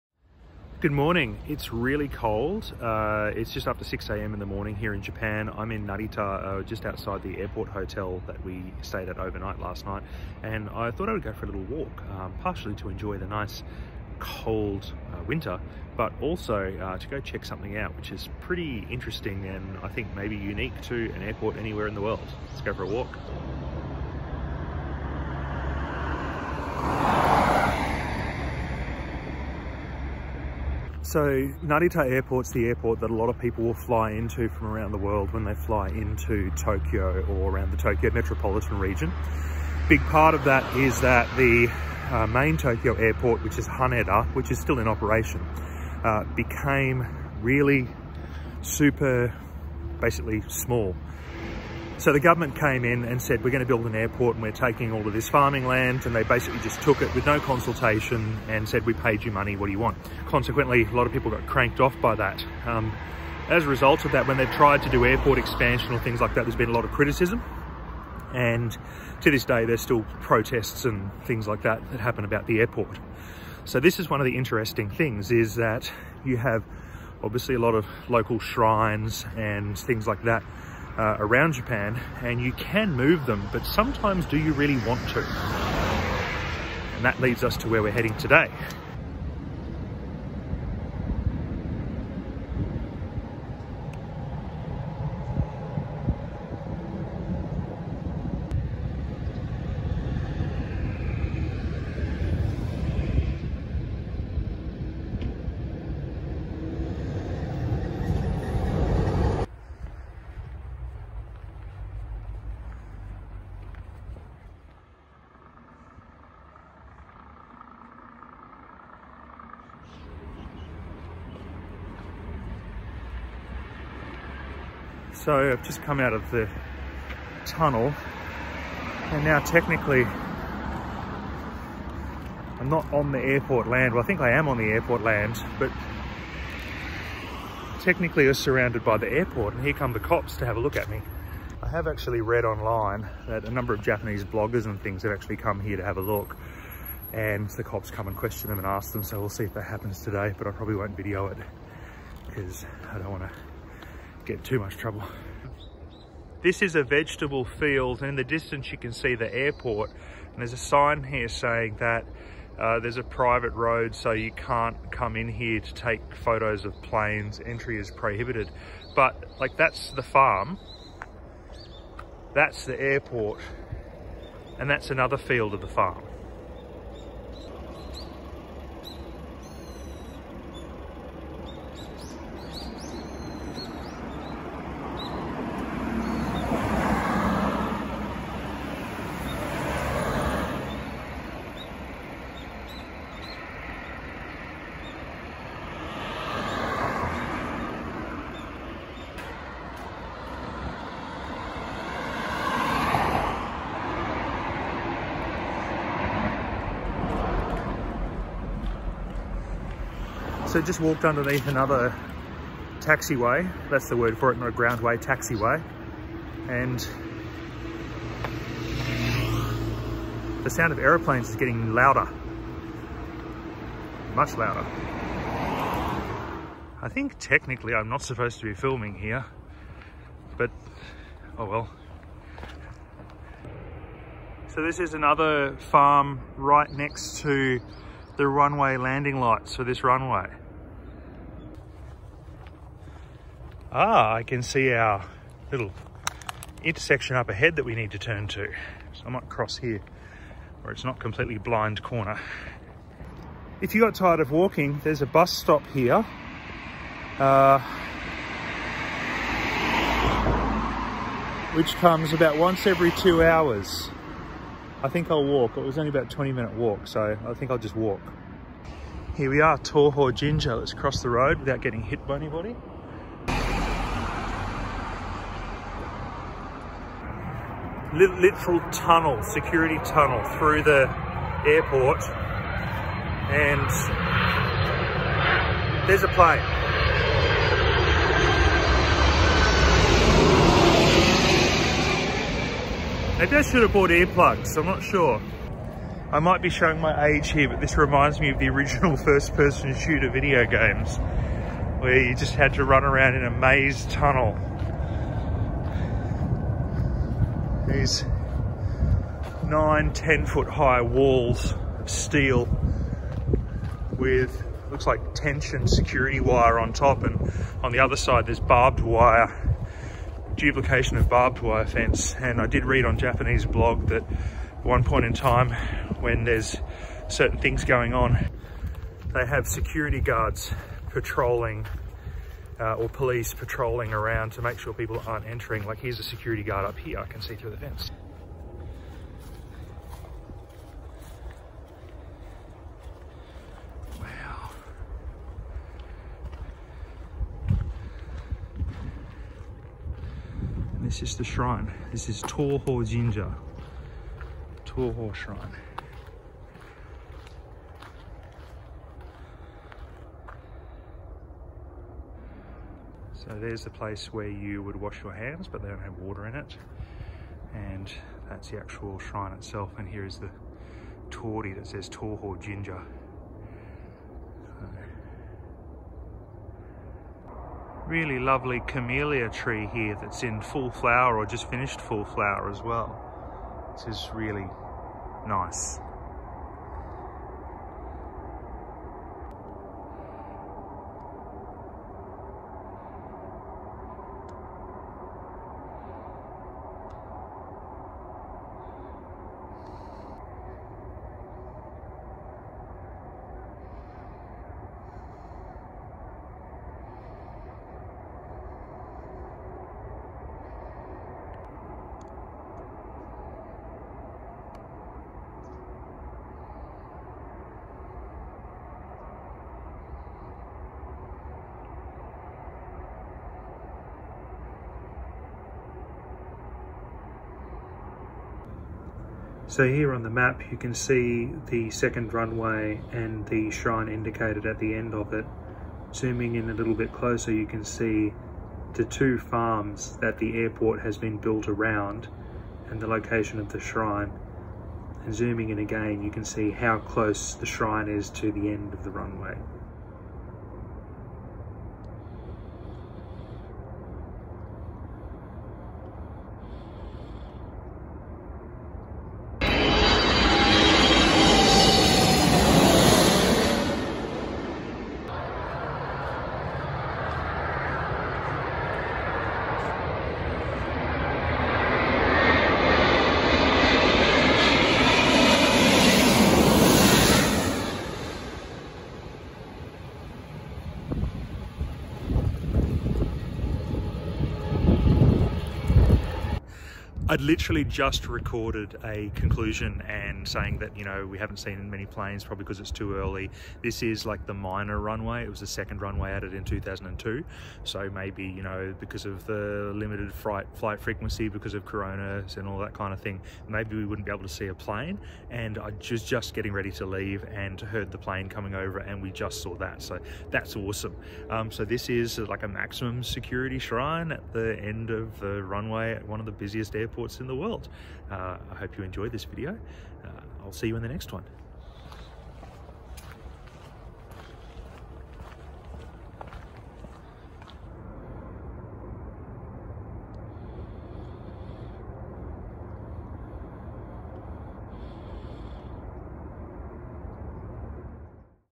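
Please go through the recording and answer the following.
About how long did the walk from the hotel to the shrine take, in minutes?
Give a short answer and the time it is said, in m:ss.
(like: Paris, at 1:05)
20, at 4:26.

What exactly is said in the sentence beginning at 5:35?
Like here's a security guard up here, I can see through the fence.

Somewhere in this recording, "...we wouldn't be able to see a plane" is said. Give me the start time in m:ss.
8:23.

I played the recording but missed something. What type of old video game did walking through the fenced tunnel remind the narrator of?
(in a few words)
First-person shooter.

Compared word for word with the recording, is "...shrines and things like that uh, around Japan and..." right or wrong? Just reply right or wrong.
right.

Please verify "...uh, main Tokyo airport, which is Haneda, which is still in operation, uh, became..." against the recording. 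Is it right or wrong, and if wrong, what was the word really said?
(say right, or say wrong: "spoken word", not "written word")
right.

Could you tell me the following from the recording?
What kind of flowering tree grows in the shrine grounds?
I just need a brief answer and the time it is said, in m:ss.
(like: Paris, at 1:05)
Camellia, at 6:18.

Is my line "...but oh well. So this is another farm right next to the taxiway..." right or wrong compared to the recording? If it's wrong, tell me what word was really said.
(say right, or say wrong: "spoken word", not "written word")
wrong: "runway", not "taxiway".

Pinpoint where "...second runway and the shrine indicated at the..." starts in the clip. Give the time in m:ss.
7:11.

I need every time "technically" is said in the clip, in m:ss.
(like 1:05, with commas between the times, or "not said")
2:09, 2:17, 3:47.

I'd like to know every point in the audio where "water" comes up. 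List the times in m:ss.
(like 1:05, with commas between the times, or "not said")
6:05.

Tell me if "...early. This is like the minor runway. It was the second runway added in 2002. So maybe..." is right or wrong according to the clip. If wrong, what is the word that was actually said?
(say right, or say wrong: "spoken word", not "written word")
right.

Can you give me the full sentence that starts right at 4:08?
So I might cross here where it's not completely blind corner.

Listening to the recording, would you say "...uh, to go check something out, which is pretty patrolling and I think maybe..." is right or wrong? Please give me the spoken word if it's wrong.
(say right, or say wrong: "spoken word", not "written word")
wrong: "interesting", not "patrolling".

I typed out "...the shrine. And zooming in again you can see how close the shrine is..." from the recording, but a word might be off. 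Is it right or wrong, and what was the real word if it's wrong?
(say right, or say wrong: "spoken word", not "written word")
right.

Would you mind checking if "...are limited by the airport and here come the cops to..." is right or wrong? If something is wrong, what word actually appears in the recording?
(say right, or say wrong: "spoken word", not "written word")
wrong: "surrounded", not "limited".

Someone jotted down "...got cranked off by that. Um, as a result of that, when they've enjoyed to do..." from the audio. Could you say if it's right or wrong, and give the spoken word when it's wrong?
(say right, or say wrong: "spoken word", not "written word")
wrong: "tried", not "enjoyed".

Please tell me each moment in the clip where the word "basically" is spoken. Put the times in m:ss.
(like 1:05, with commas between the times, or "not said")
0:49, 0:56.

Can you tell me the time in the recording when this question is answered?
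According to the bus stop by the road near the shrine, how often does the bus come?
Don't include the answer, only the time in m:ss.
4:22.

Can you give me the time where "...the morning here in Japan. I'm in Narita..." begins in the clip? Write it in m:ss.
0:04.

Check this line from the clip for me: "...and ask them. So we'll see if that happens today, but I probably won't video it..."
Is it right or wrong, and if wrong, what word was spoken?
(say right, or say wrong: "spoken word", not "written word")
right.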